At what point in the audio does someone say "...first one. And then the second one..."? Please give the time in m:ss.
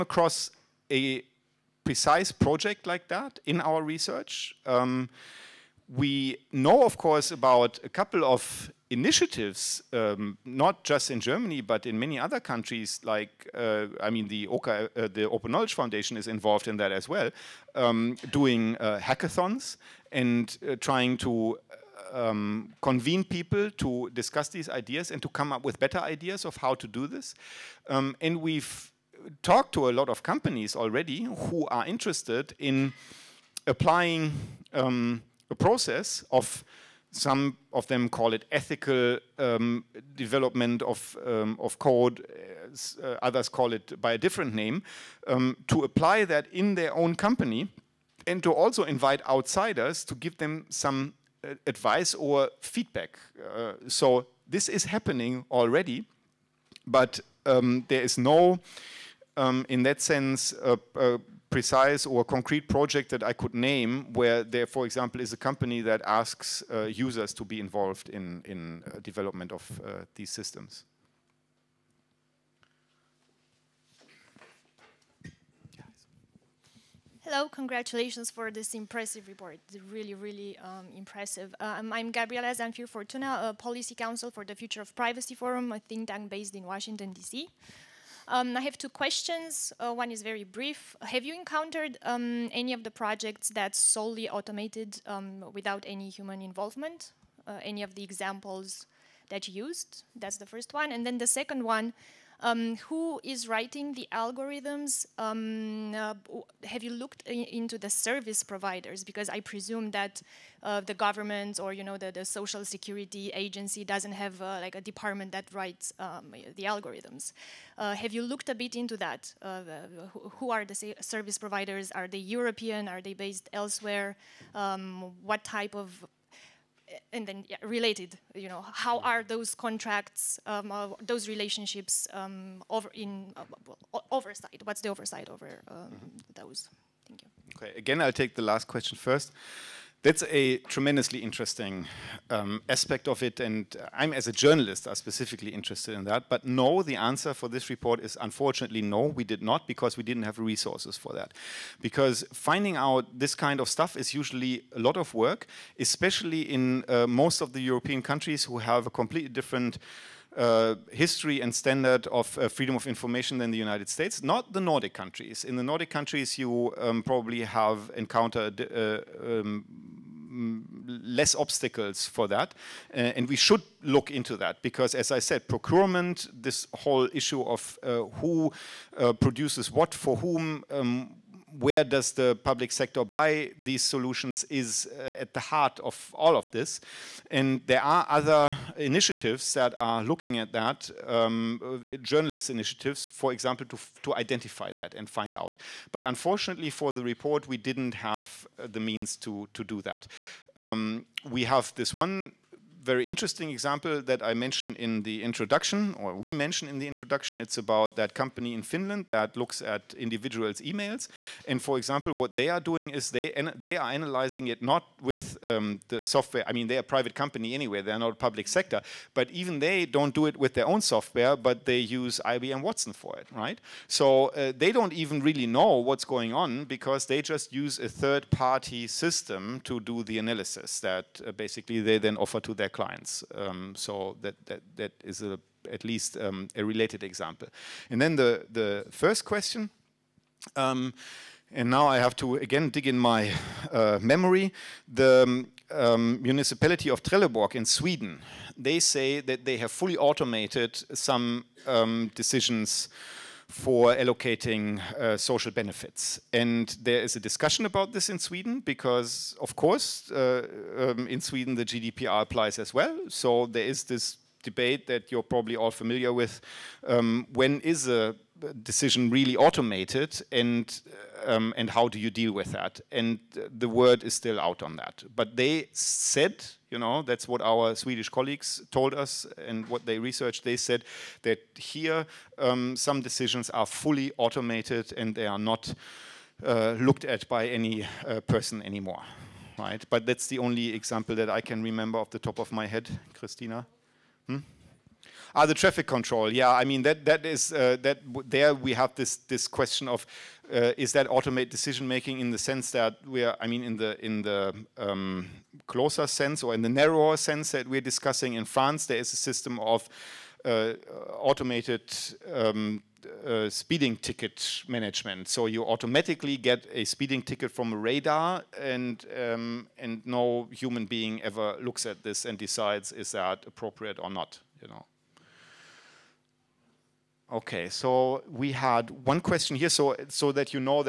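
1:40.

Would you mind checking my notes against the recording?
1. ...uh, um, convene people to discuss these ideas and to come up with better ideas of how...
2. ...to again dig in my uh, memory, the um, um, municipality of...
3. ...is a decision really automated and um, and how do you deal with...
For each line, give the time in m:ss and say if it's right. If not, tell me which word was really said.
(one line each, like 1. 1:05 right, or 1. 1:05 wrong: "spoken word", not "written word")
1. 0:22 right
2. 4:02 right
3. 4:27 right.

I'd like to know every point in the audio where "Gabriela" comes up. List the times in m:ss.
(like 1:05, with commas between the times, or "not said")
1:22.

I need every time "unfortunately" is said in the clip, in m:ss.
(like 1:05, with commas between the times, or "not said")
2:28, 3:16.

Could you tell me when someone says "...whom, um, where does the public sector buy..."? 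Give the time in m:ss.
3:00.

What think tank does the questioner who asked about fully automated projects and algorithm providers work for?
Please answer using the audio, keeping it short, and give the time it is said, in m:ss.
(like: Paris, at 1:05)
Future of Privacy Forum, at 1:24.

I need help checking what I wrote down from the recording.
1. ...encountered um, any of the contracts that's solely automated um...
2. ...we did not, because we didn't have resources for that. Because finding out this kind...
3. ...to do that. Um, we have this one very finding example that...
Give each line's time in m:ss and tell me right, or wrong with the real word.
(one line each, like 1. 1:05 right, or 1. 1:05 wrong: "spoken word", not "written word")
1. 1:31 wrong: "projects", not "contracts"
2. 2:29 right
3. 3:19 wrong: "interesting", not "finding".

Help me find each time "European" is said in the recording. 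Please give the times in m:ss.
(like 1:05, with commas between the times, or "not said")
2:02, 2:37.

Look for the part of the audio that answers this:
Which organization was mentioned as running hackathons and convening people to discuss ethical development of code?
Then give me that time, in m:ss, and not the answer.
0:15.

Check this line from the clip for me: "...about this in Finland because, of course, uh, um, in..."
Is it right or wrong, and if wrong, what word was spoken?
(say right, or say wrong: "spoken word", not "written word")
wrong: "Sweden", not "Finland".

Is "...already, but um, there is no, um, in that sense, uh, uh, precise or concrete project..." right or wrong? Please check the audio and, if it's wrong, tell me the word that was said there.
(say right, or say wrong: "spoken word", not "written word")
right.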